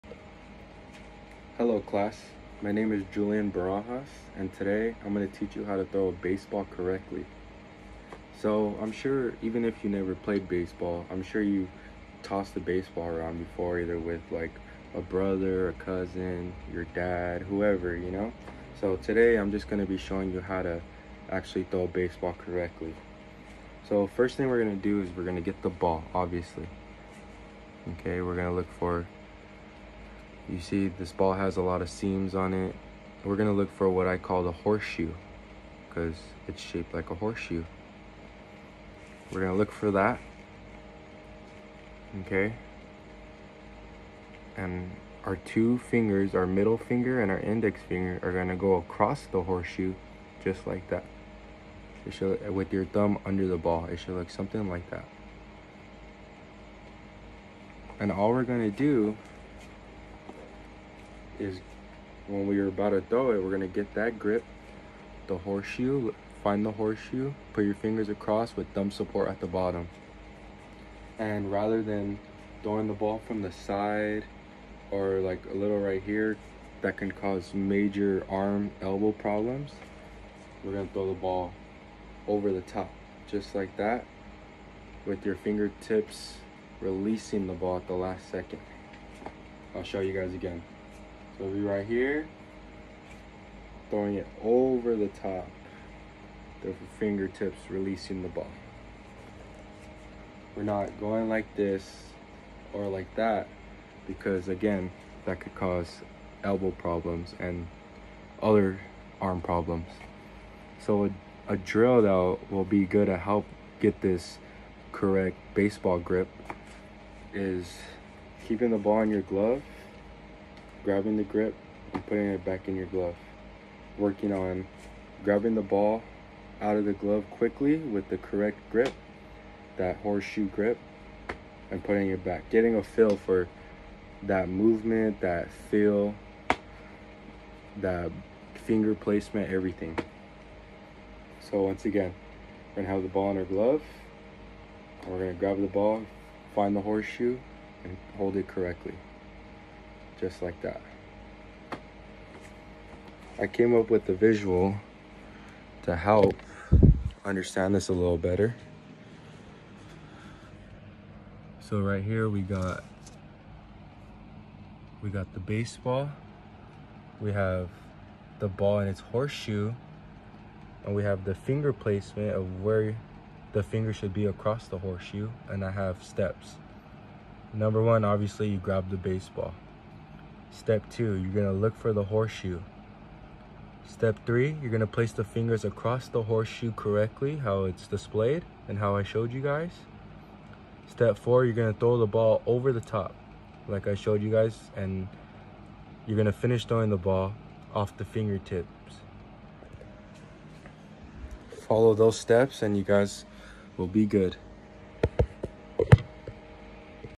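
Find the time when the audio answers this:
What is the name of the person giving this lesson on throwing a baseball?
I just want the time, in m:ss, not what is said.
0:03.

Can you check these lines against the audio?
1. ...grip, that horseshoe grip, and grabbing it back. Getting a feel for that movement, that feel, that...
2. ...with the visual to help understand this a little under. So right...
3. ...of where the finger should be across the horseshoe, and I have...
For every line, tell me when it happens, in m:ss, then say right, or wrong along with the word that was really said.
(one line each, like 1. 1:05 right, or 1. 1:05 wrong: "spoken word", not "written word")
1. 2:08 wrong: "putting", not "grabbing"
2. 2:33 wrong: "better", not "under"
3. 2:52 right.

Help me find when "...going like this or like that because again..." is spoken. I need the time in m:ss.
1:40.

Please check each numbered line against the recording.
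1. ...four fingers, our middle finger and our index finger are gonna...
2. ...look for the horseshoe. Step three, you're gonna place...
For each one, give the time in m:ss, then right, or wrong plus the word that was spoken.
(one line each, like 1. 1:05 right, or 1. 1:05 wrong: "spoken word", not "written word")
1. 0:45 wrong: "two", not "four"
2. 3:01 right.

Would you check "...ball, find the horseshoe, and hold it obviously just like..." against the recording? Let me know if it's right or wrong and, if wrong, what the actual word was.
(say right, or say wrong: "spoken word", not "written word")
wrong: "correctly", not "obviously".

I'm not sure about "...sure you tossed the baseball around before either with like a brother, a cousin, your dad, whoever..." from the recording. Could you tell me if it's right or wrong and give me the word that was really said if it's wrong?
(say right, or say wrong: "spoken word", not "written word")
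right.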